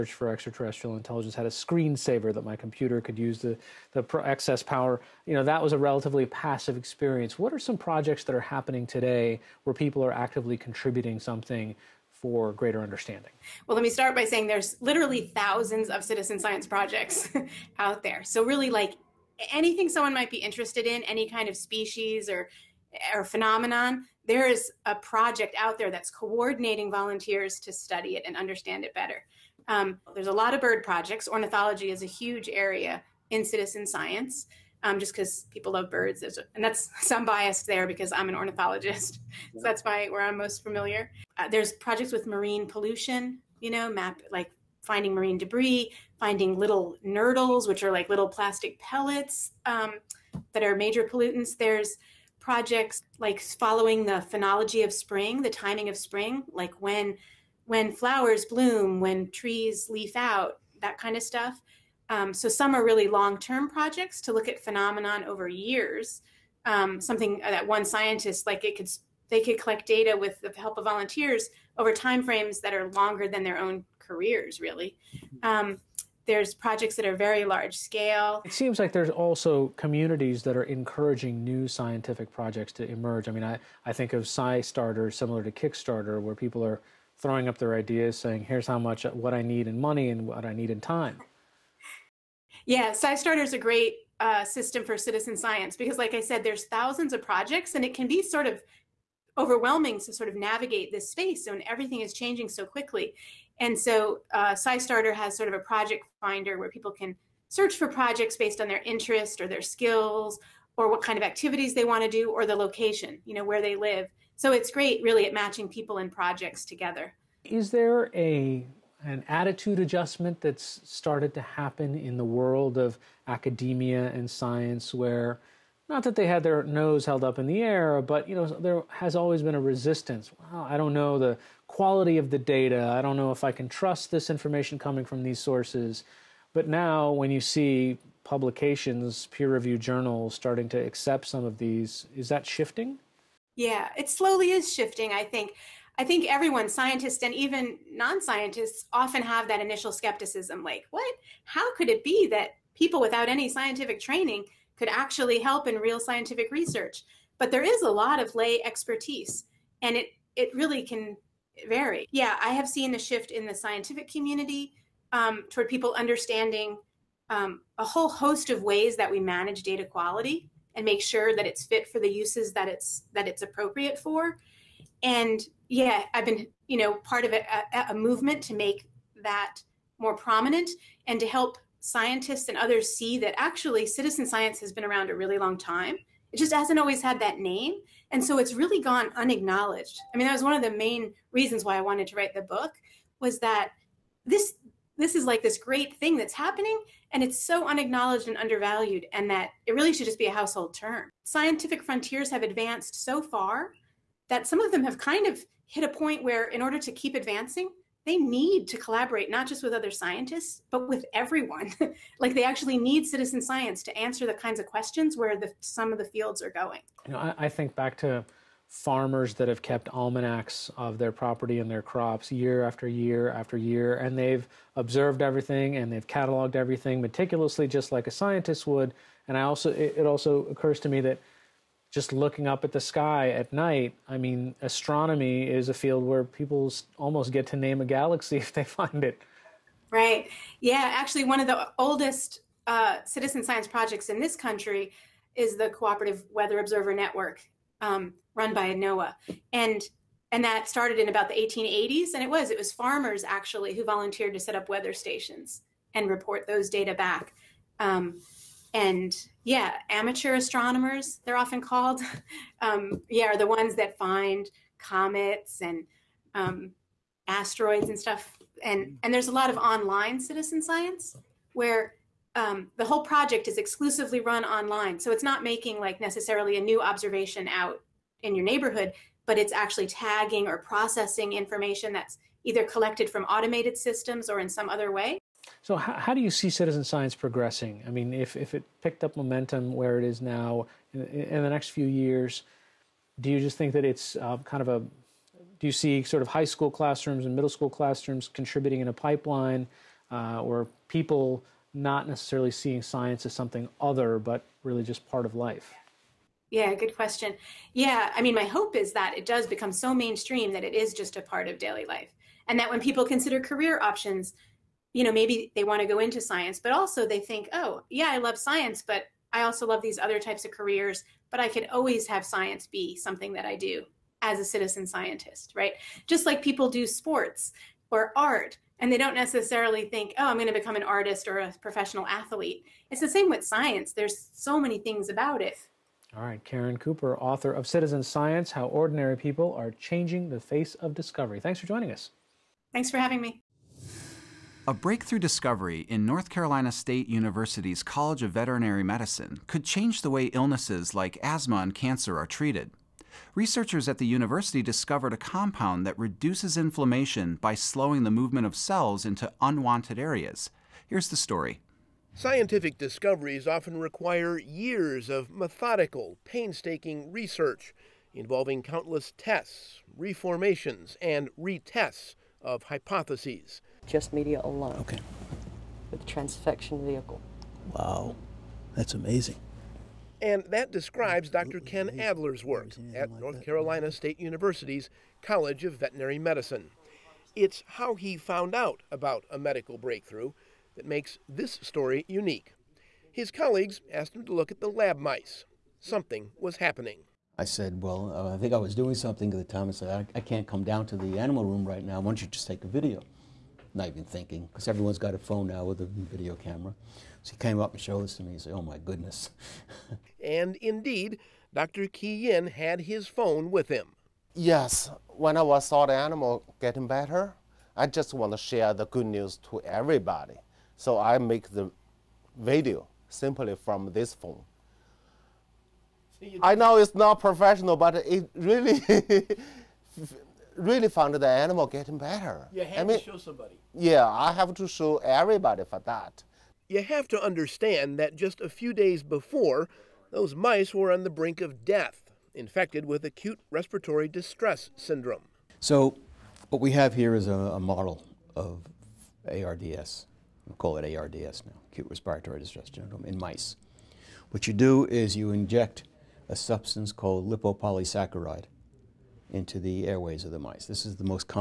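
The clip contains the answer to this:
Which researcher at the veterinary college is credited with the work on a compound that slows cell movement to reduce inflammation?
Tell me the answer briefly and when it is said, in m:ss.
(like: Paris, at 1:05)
Dr. Ken Adler, at 6:21.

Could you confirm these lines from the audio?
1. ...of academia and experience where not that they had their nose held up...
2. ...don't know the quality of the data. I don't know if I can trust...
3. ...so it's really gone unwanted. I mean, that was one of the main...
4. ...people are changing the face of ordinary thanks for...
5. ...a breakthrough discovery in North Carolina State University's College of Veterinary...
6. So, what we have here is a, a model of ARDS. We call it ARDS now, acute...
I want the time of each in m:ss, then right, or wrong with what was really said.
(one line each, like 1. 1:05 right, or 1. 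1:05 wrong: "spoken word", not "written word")
1. 2:02 wrong: "science", not "experience"
2. 2:10 right
3. 3:08 wrong: "unacknowledged", not "unwanted"
4. 5:39 wrong: "discovery", not "ordinary"
5. 5:44 right
6. 7:25 right.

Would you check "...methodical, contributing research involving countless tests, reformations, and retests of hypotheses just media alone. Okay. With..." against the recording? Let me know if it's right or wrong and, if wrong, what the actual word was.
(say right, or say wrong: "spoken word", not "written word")
wrong: "painstaking", not "contributing".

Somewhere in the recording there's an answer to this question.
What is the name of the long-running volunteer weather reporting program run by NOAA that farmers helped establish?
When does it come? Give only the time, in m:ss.
4:05.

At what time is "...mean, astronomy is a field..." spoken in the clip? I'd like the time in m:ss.
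3:54.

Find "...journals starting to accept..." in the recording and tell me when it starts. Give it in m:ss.
2:19.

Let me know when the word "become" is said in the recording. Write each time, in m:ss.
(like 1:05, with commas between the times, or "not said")
5:09, 5:30.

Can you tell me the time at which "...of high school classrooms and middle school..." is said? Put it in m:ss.
4:56.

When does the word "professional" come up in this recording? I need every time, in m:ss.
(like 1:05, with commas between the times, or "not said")
5:31, 7:07.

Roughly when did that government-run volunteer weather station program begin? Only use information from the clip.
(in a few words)
the 1880s.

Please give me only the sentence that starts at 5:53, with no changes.
Researchers at the university discovered a compound that reduces inflammation by slowing the movement of cells into unwanted areas.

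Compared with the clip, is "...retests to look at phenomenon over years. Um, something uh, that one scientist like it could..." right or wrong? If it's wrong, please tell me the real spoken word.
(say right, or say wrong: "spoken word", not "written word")
wrong: "projects", not "retests".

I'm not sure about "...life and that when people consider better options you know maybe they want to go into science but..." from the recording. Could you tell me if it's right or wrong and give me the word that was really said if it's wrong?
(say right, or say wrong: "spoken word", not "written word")
wrong: "career", not "better".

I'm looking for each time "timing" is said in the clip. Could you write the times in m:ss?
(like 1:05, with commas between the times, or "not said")
0:55.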